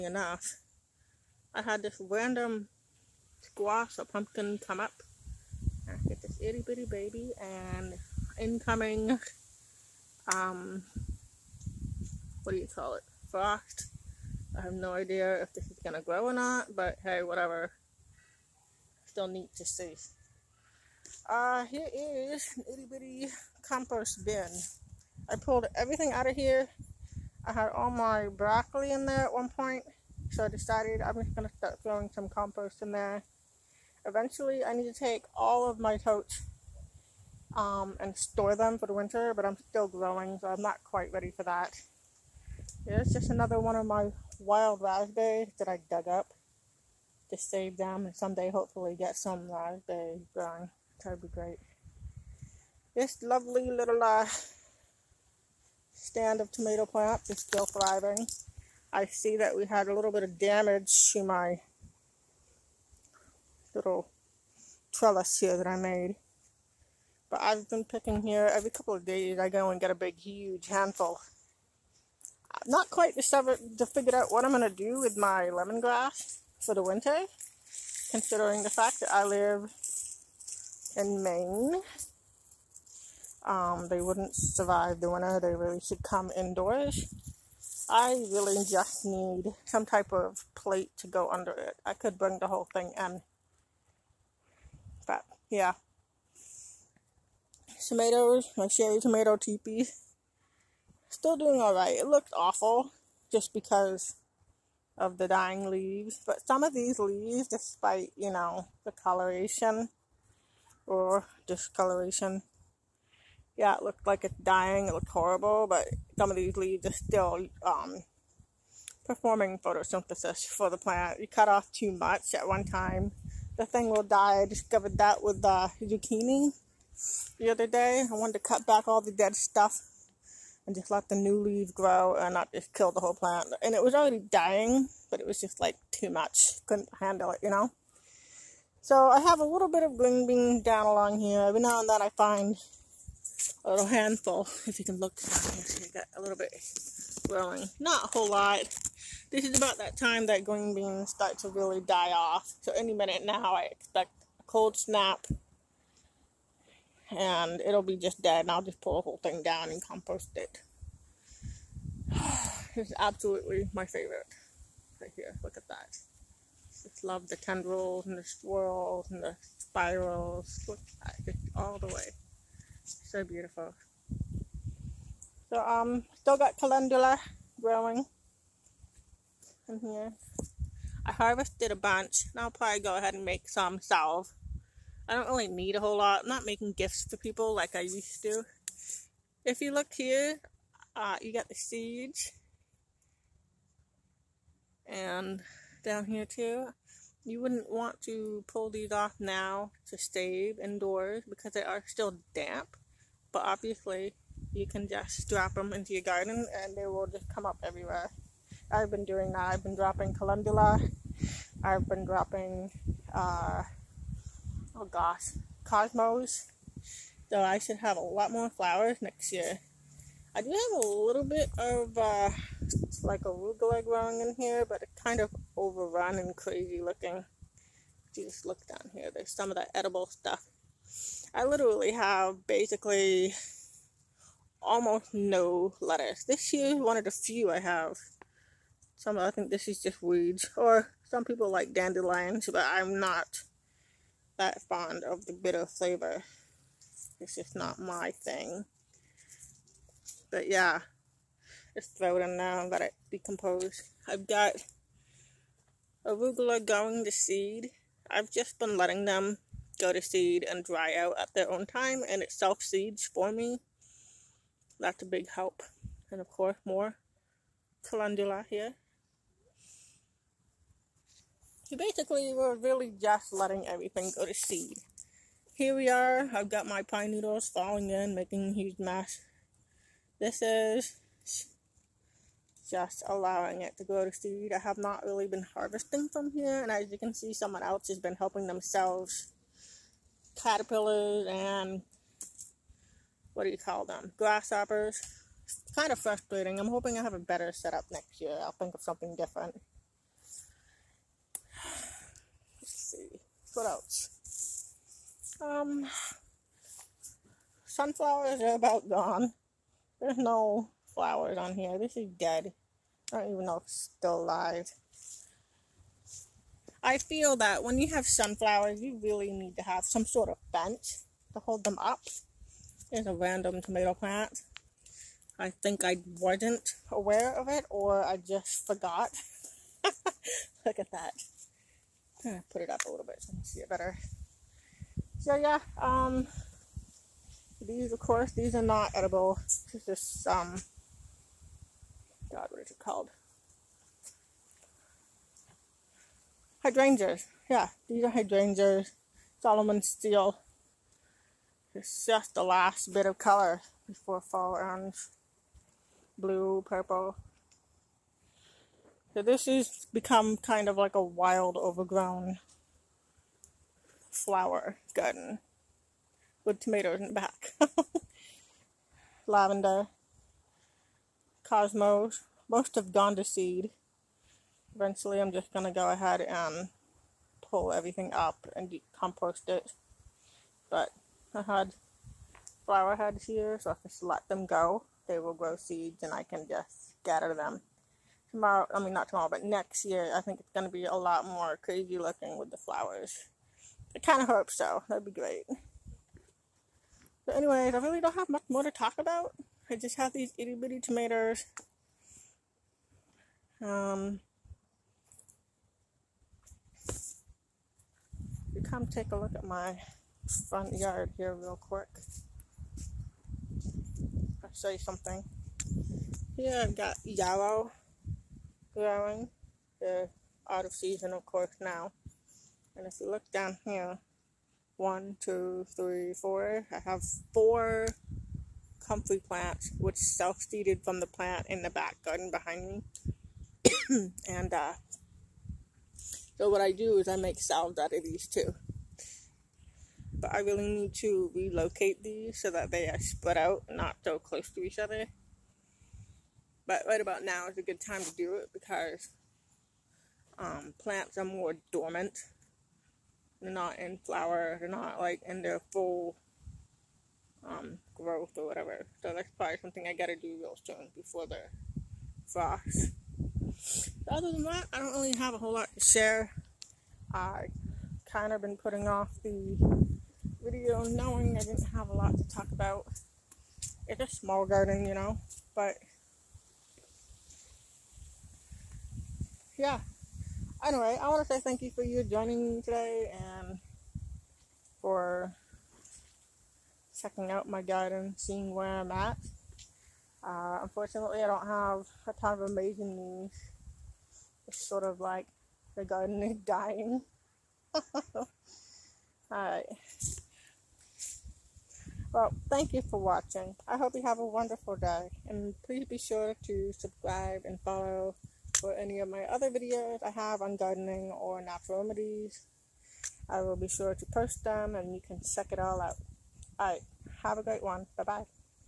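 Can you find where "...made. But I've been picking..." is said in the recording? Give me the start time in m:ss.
1:05.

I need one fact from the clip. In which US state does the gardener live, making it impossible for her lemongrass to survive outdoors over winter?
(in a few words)
Maine.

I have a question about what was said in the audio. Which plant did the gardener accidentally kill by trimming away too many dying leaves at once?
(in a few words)
Zucchini.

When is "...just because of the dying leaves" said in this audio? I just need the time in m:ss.
1:43.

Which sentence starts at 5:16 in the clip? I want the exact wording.
I feel that when you have sunflowers, you really need to have some sort of fence to hold them up.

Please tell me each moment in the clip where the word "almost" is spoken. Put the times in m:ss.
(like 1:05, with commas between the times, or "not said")
3:54.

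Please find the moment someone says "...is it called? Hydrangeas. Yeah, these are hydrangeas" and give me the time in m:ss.
5:42.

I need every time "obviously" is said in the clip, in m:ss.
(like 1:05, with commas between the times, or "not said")
3:23.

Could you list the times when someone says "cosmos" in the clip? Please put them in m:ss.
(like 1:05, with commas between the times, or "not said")
3:35, 6:11.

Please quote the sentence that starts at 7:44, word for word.
But other than that, I don't really have a whole lot to share.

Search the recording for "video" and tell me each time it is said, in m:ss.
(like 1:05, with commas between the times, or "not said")
7:50, 8:29.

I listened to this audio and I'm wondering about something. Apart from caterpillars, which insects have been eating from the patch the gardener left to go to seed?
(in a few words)
Grasshoppers.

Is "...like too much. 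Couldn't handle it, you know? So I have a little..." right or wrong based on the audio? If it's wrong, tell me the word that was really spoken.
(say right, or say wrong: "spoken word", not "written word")
right.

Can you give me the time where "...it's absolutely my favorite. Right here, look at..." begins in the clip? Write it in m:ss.
2:42.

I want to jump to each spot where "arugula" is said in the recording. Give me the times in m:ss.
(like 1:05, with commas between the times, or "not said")
3:43, 4:16.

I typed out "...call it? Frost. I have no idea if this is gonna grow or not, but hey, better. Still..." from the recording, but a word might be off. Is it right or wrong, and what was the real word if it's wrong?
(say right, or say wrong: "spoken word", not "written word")
wrong: "whatever", not "better".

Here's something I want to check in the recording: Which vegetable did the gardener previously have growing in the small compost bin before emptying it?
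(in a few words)
Broccoli.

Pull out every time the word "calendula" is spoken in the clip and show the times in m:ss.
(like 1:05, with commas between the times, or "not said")
2:56, 3:30, 4:27.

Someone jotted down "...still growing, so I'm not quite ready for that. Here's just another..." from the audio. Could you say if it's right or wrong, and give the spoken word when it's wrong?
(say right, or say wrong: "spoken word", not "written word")
right.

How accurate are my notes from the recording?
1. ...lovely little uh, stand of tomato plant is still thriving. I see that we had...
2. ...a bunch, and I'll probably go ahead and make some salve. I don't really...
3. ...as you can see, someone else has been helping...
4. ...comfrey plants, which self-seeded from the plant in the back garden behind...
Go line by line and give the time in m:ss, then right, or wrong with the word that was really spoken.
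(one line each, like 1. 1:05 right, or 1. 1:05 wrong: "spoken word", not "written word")
1. 0:53 right
2. 3:01 right
3. 4:46 right
4. 7:08 right.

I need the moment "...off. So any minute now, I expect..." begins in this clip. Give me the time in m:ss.
2:32.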